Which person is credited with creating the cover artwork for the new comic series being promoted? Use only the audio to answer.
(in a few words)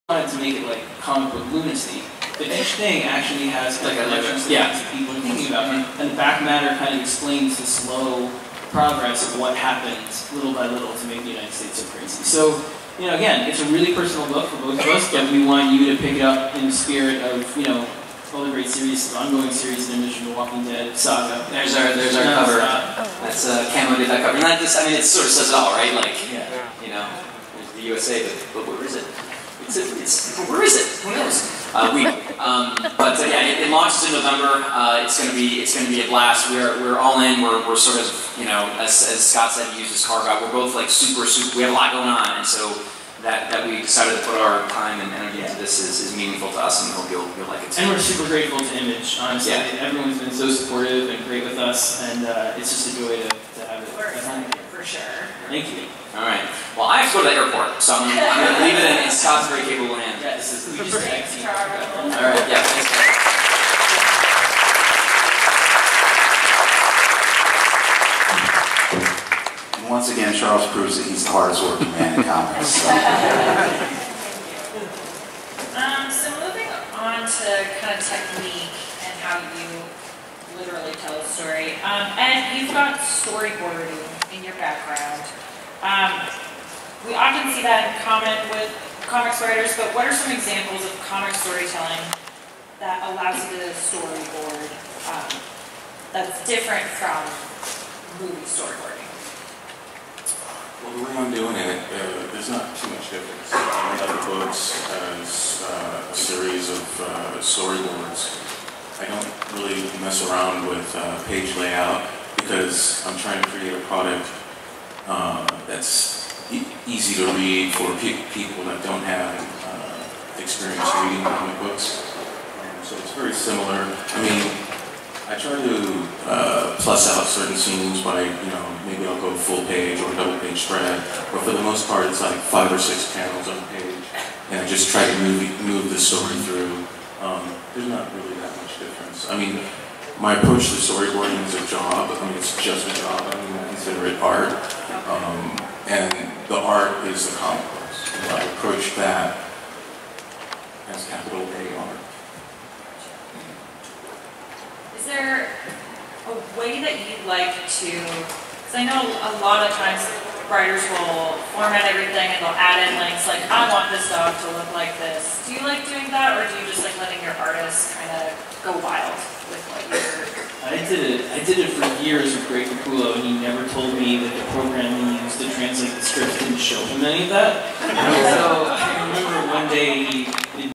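Camo.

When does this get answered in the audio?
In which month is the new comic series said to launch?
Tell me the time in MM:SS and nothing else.
00:34.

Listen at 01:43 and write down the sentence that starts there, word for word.
I have up books as uh, a series of uh, storyboards.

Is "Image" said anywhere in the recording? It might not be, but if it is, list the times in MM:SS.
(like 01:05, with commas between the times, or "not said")
00:48.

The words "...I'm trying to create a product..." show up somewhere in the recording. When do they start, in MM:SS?
01:53.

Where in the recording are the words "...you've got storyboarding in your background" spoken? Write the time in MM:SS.
01:22.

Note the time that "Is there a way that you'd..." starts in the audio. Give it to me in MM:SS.
02:34.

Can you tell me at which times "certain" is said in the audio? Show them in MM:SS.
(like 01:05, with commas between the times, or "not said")
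02:07.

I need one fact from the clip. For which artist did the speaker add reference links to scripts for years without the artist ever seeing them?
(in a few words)
Greg Capullo.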